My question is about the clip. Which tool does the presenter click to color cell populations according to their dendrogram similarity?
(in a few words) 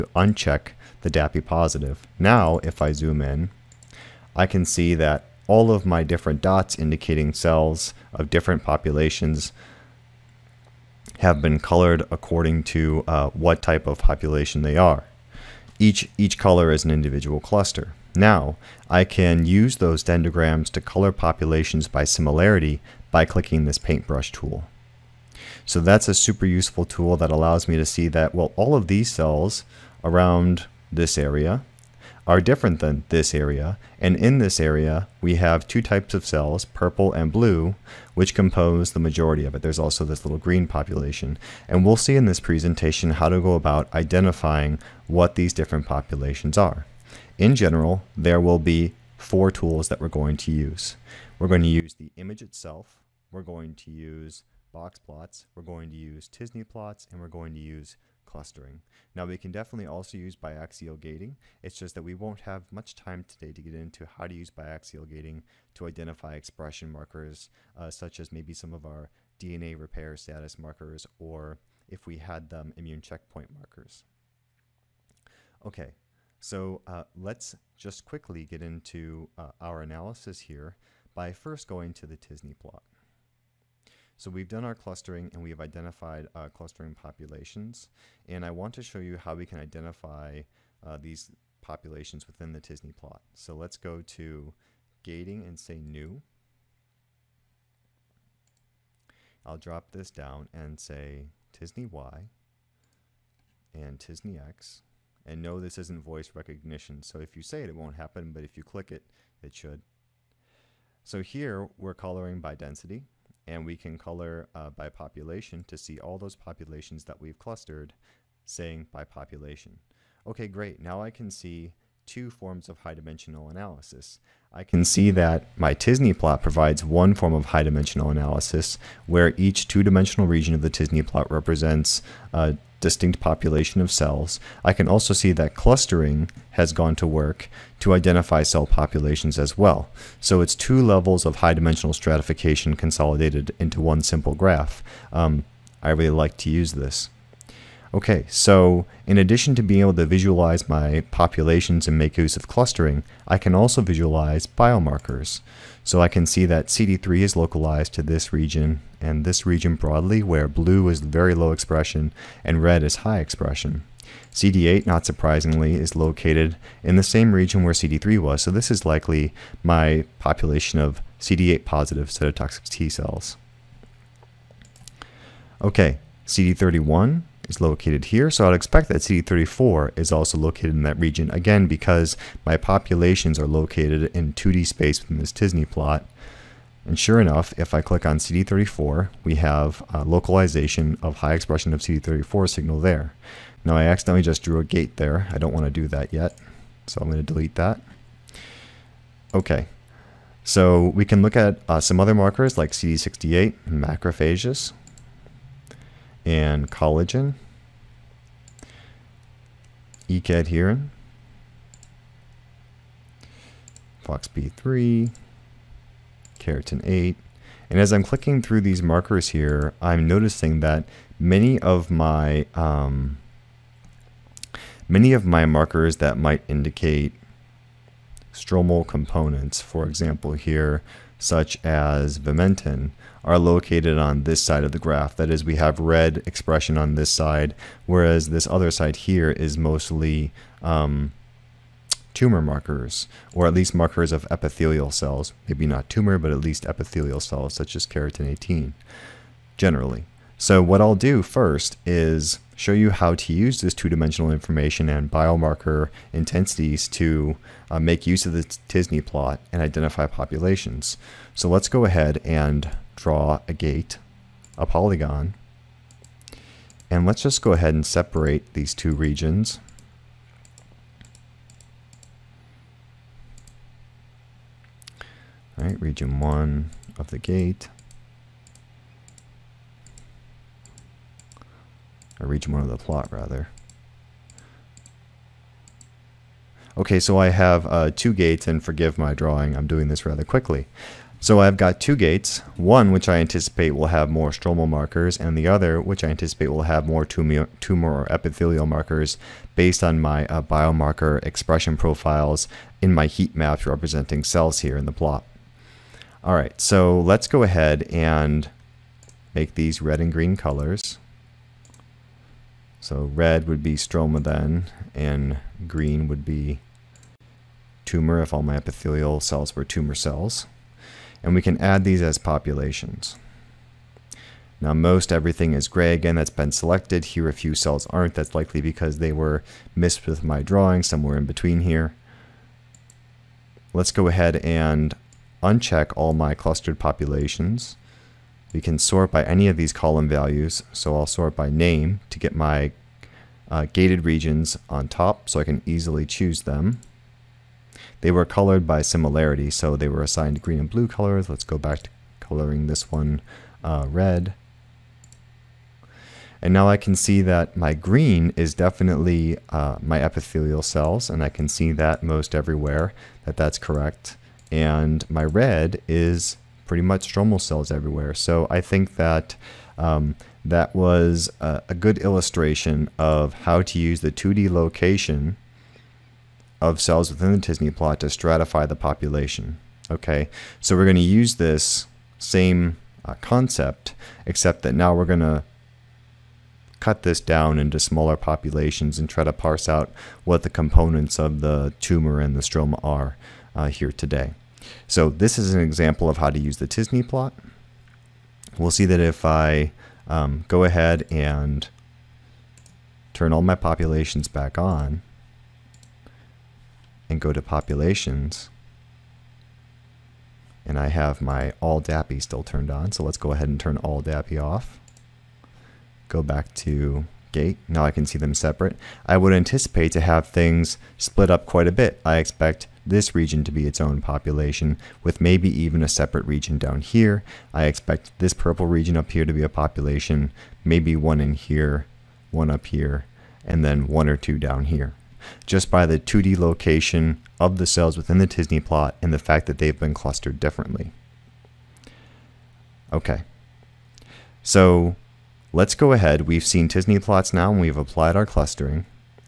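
paintbrush tool.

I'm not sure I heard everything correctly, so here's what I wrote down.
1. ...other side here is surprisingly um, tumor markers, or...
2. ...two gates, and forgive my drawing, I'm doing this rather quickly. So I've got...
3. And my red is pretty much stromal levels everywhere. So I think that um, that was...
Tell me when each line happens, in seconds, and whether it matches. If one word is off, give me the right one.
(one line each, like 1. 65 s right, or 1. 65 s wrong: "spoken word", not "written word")
1. 238 s wrong: "mostly", not "surprisingly"
2. 287 s right
3. 364 s wrong: "cells", not "levels".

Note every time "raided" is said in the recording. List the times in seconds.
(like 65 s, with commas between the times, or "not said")
not said.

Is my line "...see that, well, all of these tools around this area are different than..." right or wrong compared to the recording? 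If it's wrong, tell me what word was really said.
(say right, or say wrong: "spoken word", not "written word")
wrong: "cells", not "tools".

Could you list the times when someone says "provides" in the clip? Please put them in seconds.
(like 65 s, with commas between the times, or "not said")
126 s.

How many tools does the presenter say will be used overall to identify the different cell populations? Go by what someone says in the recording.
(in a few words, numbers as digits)
4.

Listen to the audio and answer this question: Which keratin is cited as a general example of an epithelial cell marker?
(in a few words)
keratin 18.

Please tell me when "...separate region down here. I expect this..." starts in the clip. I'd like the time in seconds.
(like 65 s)
425 s.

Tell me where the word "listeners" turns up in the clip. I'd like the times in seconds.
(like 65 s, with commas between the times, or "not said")
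not said.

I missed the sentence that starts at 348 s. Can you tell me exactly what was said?
They were colored by similarity, so they were assigned green and blue colors.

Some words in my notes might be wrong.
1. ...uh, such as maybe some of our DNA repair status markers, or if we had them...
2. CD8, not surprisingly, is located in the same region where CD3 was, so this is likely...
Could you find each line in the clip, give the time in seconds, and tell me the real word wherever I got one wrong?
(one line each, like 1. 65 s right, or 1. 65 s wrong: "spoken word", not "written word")
1. 67 s right
2. 164 s right.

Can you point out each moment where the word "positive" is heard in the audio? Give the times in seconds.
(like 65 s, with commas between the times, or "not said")
1 s, 171 s.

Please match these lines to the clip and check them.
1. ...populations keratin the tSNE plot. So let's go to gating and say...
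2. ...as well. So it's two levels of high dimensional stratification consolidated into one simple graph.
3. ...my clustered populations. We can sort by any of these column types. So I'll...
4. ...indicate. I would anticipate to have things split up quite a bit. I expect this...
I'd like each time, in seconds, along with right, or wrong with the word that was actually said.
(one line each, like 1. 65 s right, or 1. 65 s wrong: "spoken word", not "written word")
1. 91 s wrong: "within", not "keratin"
2. 139 s right
3. 336 s wrong: "values", not "types"
4. 418 s wrong: "separate", not "indicate".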